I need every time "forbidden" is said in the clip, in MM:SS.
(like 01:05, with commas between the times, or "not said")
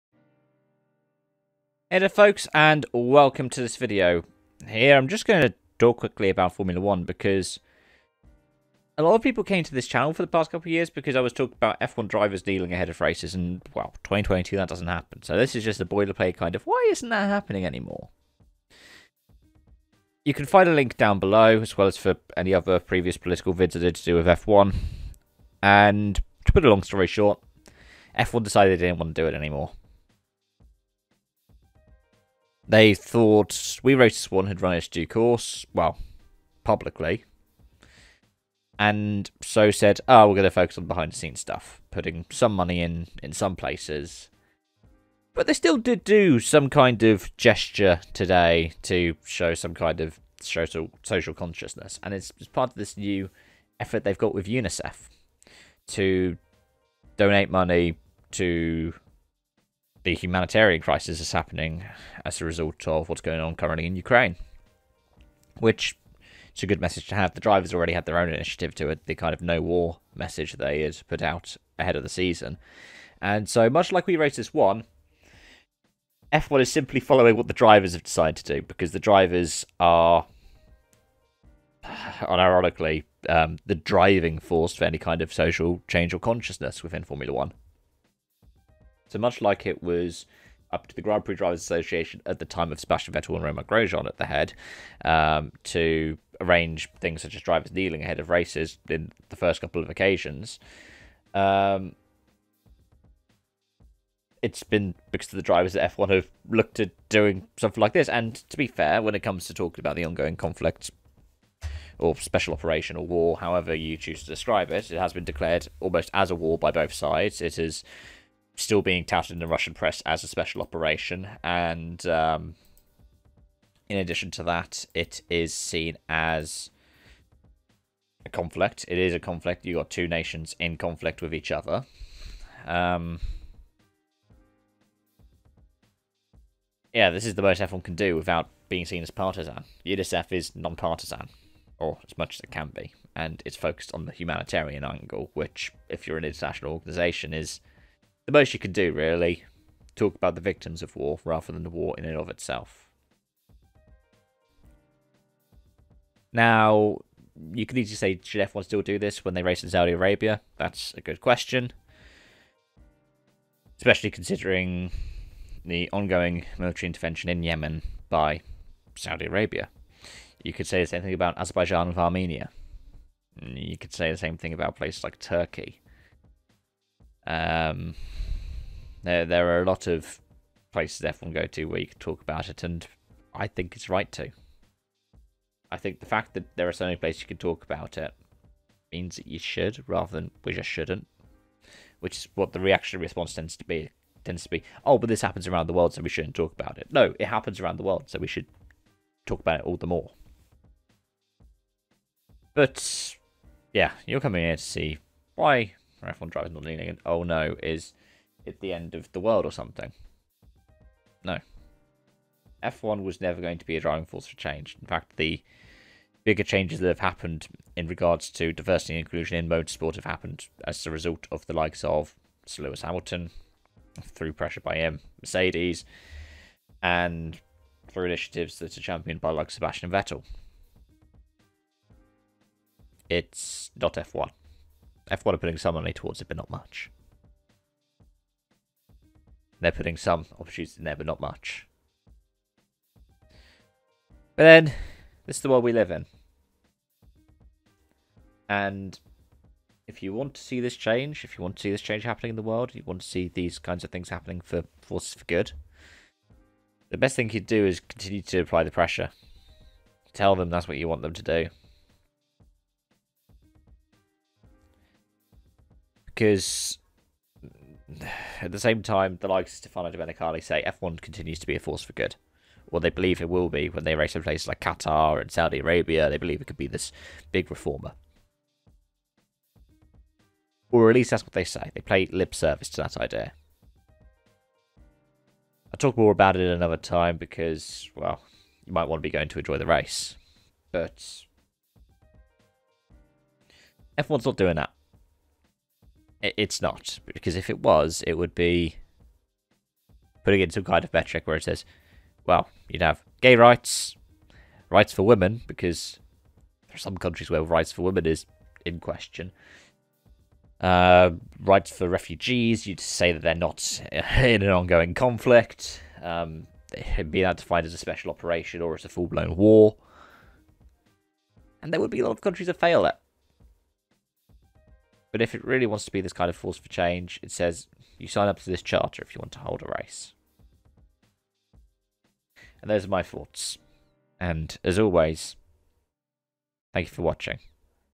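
not said.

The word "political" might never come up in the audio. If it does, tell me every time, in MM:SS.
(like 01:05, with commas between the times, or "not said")
00:23.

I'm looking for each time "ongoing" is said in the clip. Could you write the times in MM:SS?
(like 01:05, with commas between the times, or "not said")
01:50, 02:45, 05:14.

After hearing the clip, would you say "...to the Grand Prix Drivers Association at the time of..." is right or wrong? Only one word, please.
right.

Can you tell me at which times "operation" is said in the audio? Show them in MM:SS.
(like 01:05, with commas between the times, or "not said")
01:52, 02:00, 05:18.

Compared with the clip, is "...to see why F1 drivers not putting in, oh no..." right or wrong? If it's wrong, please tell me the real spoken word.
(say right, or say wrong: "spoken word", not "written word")
wrong: "leaning", not "putting".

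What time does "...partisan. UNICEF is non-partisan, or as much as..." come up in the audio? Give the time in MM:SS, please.
02:19.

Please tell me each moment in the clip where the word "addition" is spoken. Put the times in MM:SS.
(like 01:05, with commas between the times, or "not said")
02:03.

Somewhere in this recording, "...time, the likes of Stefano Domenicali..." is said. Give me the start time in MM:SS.
04:28.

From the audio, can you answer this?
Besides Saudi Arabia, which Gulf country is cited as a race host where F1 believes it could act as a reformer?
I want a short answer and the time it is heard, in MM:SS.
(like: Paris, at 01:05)
Qatar, at 04:34.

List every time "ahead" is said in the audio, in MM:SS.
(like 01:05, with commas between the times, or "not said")
00:12, 01:11, 01:38.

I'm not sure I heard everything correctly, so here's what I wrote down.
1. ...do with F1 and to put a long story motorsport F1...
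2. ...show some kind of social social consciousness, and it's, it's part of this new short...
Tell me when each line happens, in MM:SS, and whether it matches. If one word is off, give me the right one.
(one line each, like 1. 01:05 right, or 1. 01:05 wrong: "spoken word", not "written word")
1. 00:24 wrong: "short", not "motorsport"
2. 00:49 wrong: "effort", not "short".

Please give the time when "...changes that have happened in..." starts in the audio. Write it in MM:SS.
03:36.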